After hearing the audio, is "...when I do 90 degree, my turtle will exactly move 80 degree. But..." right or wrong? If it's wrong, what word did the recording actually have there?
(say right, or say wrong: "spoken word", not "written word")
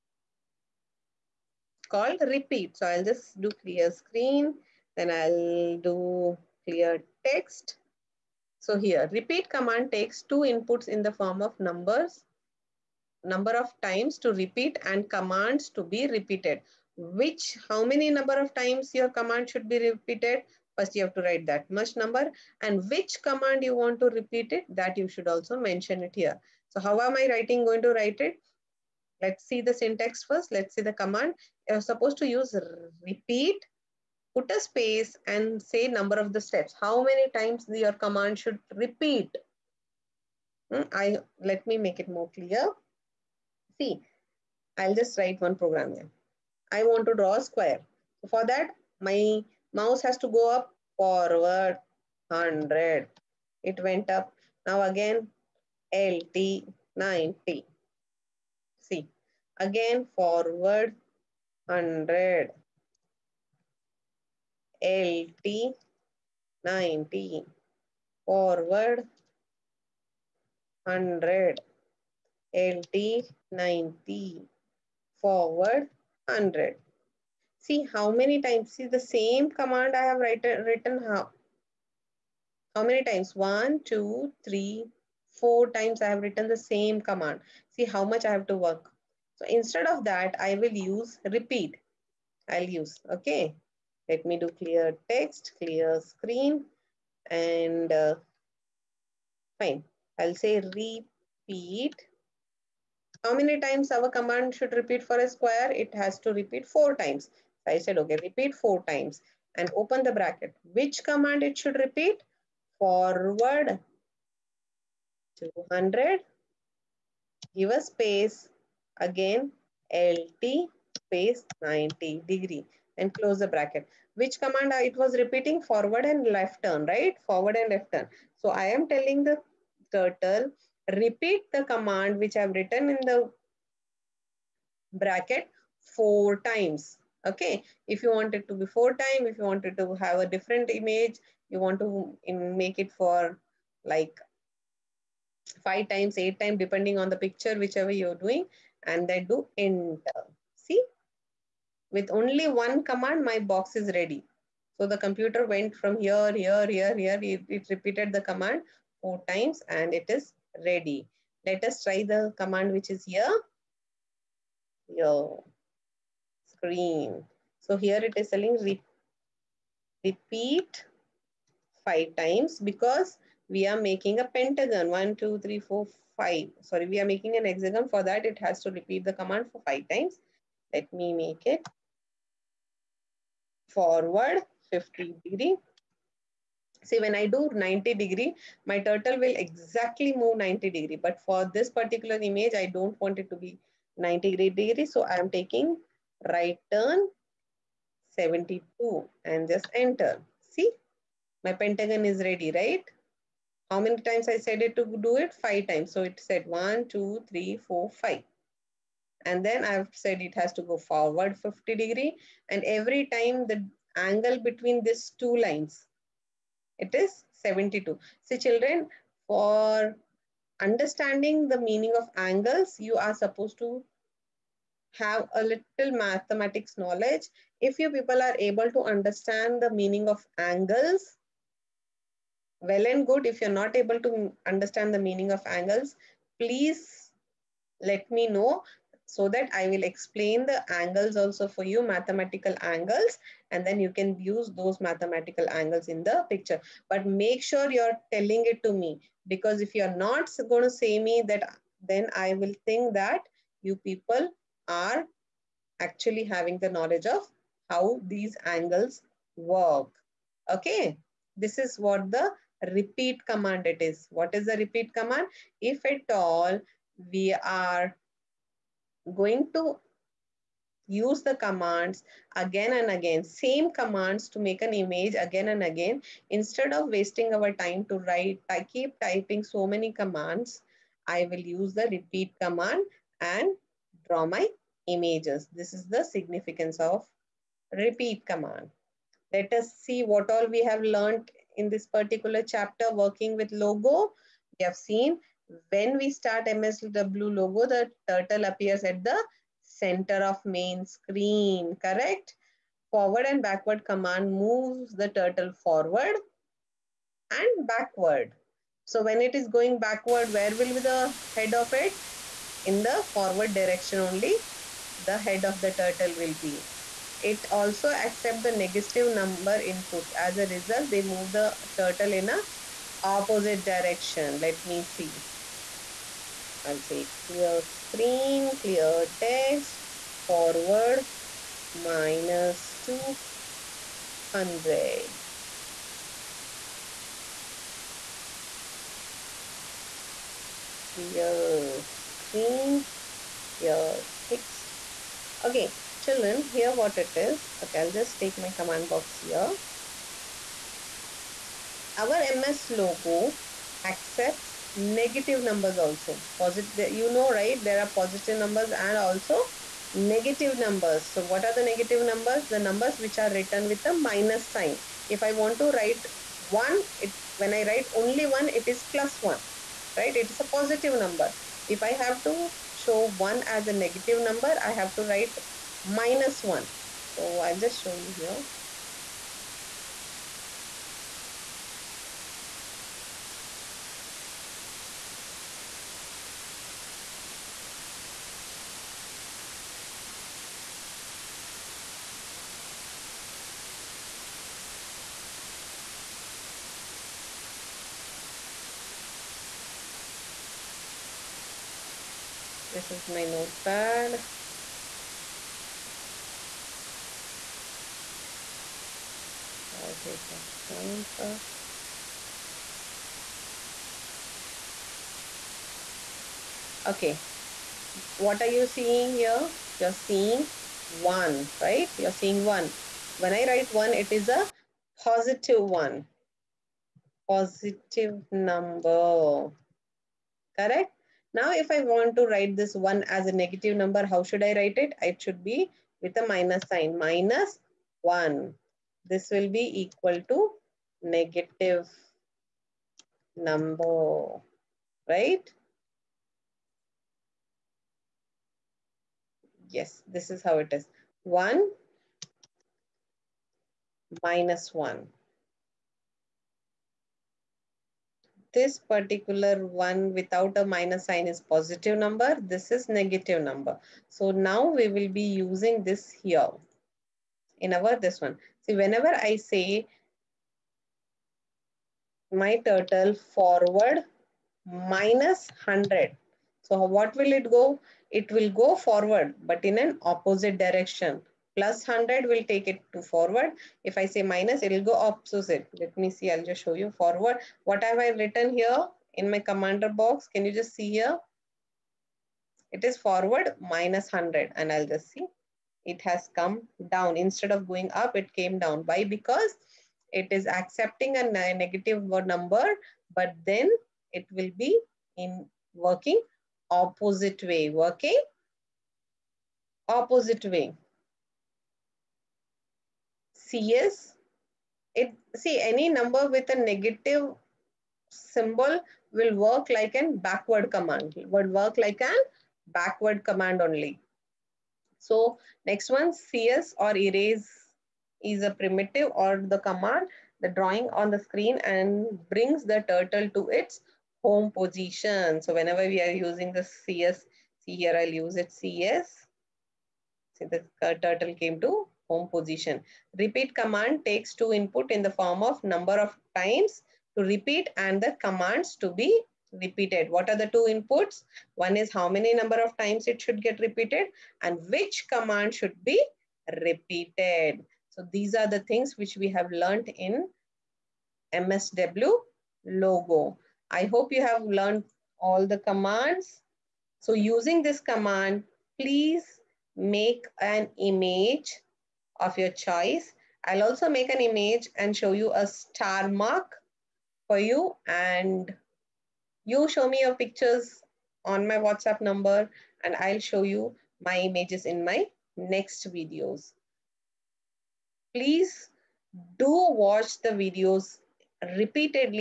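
wrong: "90", not "80".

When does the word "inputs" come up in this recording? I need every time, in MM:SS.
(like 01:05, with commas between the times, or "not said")
00:10, 05:19, 09:04, 09:10.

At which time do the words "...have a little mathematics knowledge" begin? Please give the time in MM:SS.
03:44.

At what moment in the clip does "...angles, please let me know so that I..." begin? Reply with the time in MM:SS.
03:55.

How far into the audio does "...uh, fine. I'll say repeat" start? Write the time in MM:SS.
01:37.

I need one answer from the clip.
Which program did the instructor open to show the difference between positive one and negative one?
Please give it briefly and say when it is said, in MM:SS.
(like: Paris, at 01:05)
Notepad, at 06:43.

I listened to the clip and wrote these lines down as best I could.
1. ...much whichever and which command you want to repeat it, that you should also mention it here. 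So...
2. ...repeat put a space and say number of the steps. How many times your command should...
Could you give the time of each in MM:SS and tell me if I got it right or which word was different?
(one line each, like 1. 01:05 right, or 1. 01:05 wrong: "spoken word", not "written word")
1. 00:21 wrong: "number", not "whichever"
2. 00:33 right.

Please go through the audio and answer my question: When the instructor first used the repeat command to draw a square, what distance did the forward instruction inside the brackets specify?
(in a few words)
200.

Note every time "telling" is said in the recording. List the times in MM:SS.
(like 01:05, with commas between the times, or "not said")
02:08, 02:48, 04:08.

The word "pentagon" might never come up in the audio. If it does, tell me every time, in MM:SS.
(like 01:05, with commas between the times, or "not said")
02:54, 03:21.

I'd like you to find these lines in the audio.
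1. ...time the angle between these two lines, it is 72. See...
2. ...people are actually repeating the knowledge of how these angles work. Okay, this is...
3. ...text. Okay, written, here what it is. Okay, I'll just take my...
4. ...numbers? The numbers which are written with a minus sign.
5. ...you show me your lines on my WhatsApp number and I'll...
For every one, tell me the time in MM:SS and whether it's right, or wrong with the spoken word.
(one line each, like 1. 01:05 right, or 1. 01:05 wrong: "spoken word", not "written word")
1. 03:33 right
2. 04:13 wrong: "having", not "repeating"
3. 05:44 wrong: "children", not "written"
4. 06:02 right
5. 09:39 wrong: "pictures", not "lines".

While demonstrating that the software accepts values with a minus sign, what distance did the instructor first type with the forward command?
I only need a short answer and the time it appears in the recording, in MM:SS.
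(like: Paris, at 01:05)
-200, at 05:30.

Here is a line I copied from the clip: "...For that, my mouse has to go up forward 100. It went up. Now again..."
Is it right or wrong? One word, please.
right.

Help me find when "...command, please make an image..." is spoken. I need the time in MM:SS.
09:27.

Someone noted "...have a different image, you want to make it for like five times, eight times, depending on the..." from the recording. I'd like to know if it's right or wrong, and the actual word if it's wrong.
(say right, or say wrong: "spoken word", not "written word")
right.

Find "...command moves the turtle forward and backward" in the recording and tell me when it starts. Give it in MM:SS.
05:03.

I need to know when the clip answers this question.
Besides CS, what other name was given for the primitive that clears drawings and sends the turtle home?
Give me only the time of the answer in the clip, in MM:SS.
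08:46.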